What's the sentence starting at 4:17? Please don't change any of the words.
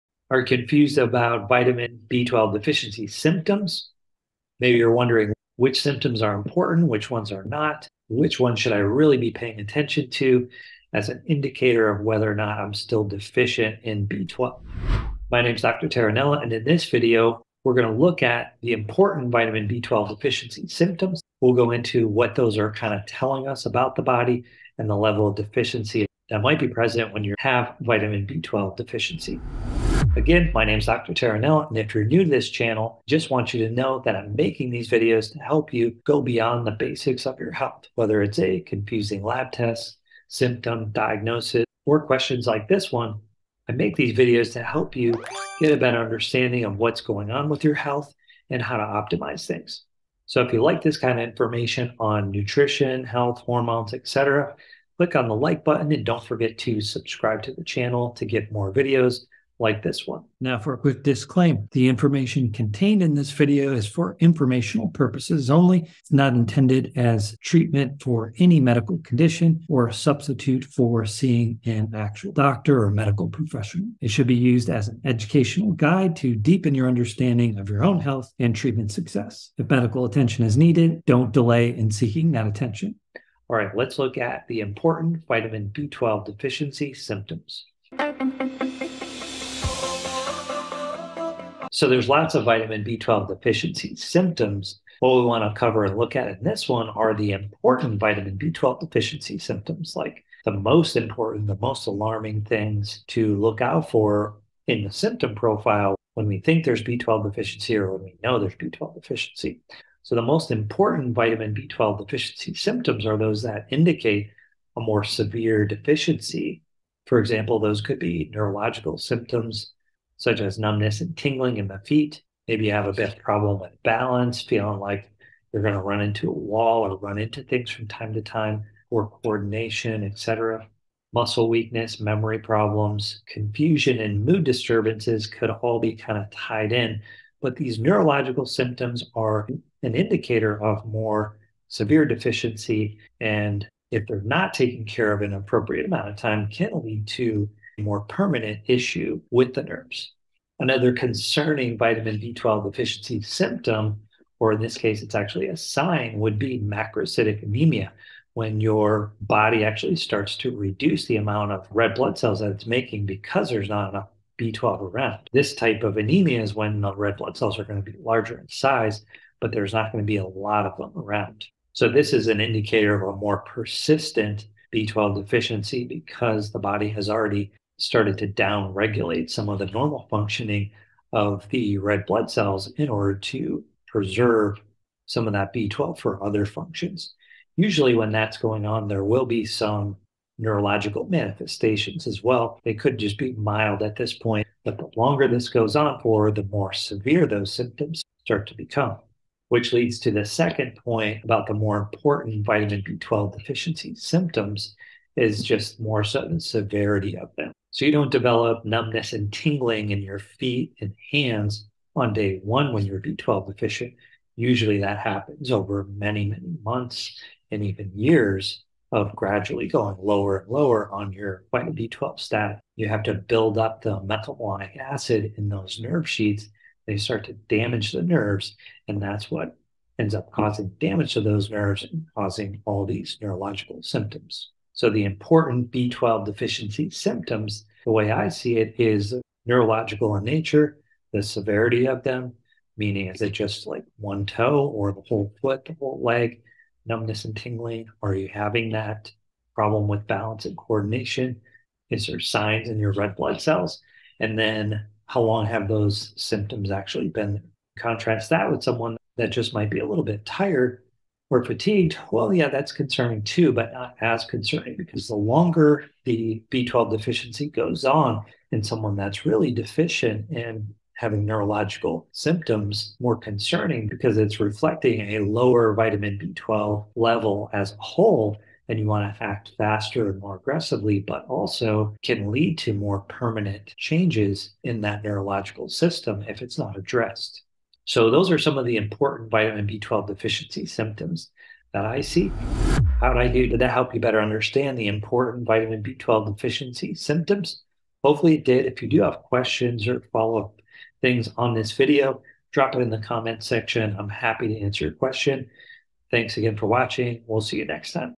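Contrast that with someone that just might be a little bit tired we're fatigued.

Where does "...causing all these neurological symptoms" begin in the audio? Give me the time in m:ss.
3:52.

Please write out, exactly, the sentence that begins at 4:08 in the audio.
Are you having that problem with balance and coordination?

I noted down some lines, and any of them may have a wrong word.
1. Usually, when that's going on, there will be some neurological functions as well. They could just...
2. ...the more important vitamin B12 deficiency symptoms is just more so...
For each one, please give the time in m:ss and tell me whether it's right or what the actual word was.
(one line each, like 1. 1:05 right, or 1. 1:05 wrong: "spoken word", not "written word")
1. 3:07 wrong: "manifestations", not "functions"
2. 3:21 right.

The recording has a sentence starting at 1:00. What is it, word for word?
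Now, for a quick disclaimer the information contained in this video is for informational purposes only.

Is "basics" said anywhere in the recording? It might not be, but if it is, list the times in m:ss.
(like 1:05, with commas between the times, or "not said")
0:36.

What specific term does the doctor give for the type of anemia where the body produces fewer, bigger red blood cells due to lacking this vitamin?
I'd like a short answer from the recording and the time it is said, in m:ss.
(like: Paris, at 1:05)
macrocytic anemia, at 2:36.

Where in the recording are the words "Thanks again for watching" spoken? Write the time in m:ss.
5:06.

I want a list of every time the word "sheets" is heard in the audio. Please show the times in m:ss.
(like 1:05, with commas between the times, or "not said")
3:46.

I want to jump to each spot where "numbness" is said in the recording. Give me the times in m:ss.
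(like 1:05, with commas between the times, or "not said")
2:00, 3:28, 4:06.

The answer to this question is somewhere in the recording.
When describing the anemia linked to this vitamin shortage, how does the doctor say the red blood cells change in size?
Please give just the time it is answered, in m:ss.
2:47.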